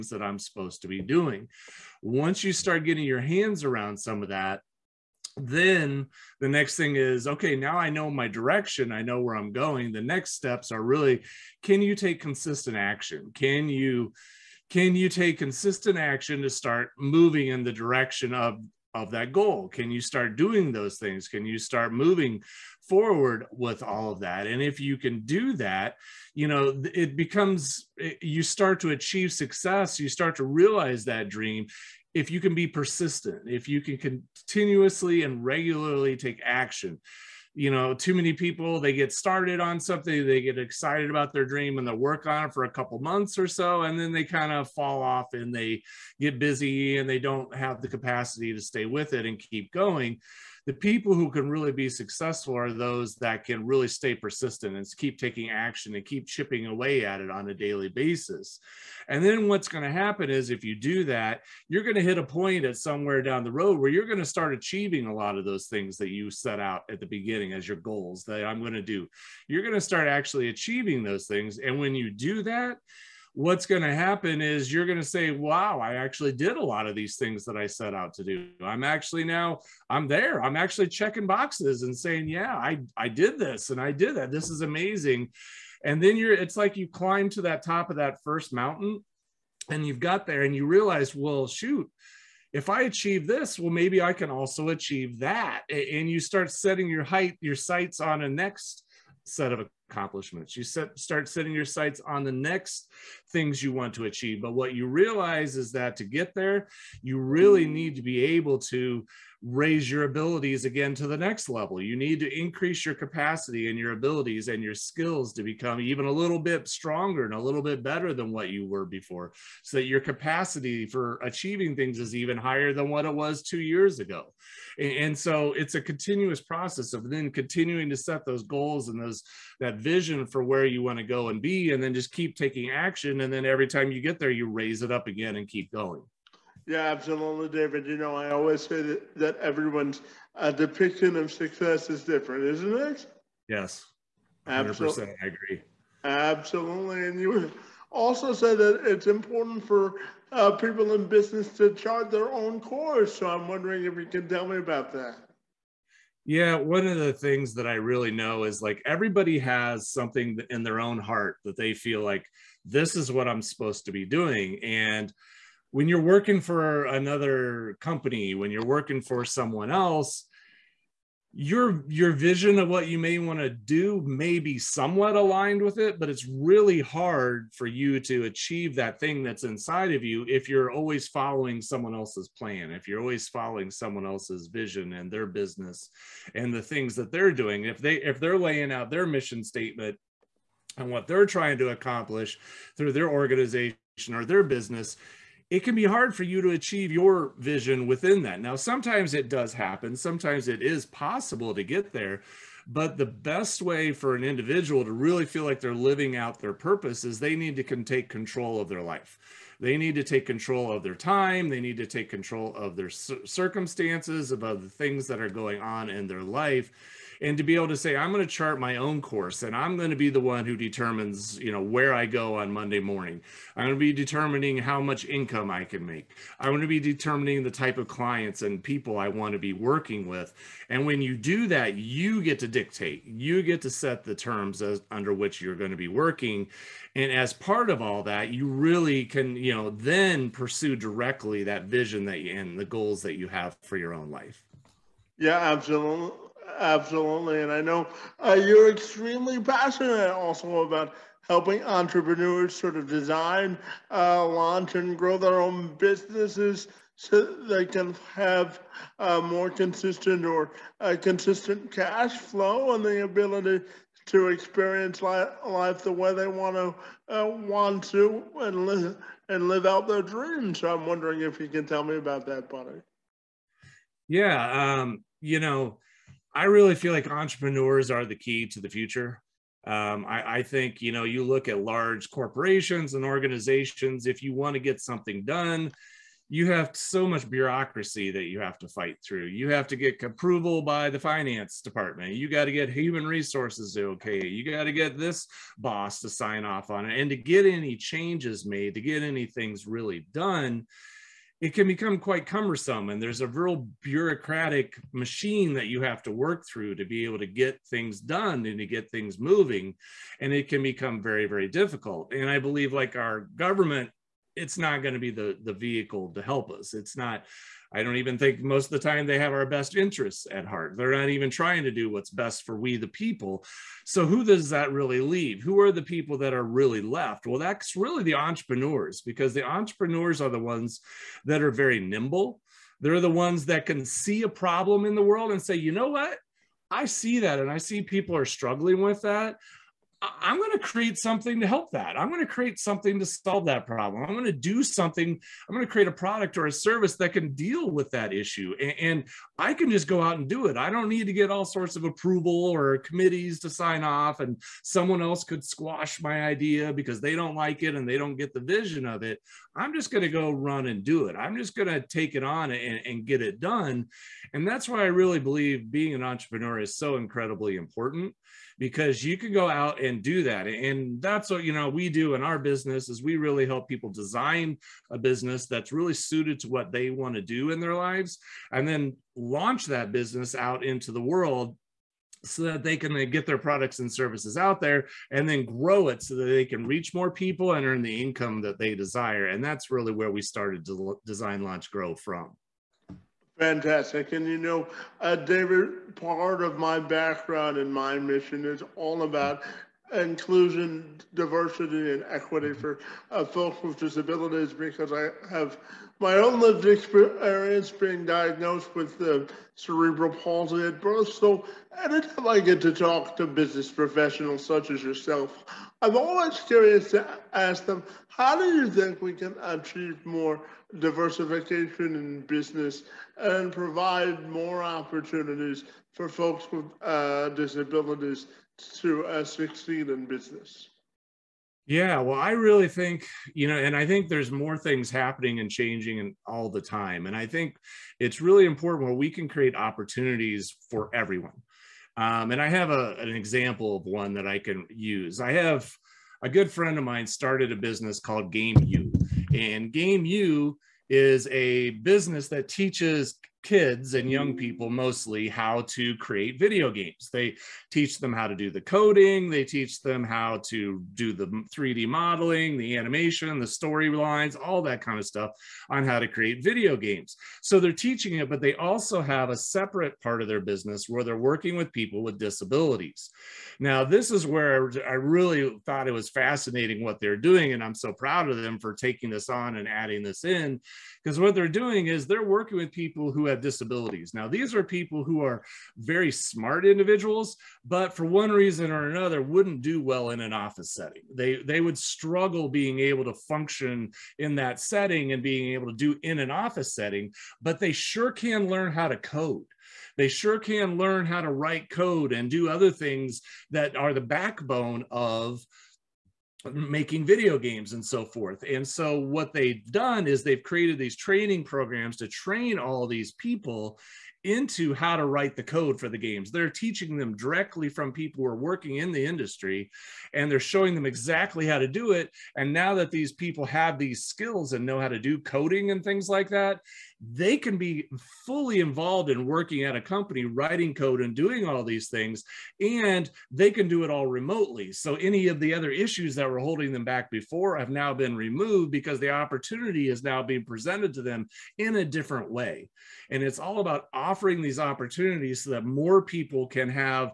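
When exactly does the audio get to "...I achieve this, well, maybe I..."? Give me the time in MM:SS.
01:32.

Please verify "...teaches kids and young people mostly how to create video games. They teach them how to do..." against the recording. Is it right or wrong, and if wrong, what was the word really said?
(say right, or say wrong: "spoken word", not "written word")
right.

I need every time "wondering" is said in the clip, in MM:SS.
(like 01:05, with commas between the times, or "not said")
02:33, 04:30.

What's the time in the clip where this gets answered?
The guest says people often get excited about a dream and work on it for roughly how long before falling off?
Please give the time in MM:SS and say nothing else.
00:42.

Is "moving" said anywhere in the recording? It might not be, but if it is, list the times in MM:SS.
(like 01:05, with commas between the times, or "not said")
00:16, 00:21, 05:09.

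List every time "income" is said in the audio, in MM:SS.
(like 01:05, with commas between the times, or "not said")
03:45, 06:28.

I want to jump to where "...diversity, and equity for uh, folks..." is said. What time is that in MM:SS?
06:41.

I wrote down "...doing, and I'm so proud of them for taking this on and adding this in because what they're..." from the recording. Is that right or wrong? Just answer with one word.
right.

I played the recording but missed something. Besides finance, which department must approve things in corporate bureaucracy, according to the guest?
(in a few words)
human resources.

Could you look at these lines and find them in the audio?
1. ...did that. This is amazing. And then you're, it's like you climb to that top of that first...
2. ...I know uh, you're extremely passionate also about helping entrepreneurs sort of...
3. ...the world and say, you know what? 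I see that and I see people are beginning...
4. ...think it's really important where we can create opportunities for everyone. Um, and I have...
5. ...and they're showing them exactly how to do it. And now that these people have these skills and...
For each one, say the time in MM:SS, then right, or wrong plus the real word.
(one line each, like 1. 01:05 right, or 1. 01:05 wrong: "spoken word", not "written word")
1. 01:23 right
2. 04:07 right
3. 05:34 wrong: "struggling", not "beginning"
4. 07:17 right
5. 08:40 right.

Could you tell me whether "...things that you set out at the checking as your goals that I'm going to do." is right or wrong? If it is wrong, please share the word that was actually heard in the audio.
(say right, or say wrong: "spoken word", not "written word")
wrong: "beginning", not "checking".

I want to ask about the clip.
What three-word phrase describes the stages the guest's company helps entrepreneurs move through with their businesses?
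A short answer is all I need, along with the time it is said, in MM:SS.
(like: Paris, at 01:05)
design launch grow, at 06:31.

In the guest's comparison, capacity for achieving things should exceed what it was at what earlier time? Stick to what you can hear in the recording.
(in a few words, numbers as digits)
two years ago.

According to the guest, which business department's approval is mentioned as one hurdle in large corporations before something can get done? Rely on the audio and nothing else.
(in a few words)
finance department.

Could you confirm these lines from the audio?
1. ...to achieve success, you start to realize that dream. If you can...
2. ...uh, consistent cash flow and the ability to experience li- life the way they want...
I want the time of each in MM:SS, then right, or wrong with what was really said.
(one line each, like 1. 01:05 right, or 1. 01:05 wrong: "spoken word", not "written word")
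1. 00:28 right
2. 04:20 right.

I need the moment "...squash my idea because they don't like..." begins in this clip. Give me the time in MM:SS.
05:55.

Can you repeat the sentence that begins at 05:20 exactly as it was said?
They're not even trying to do what's best for we, the people.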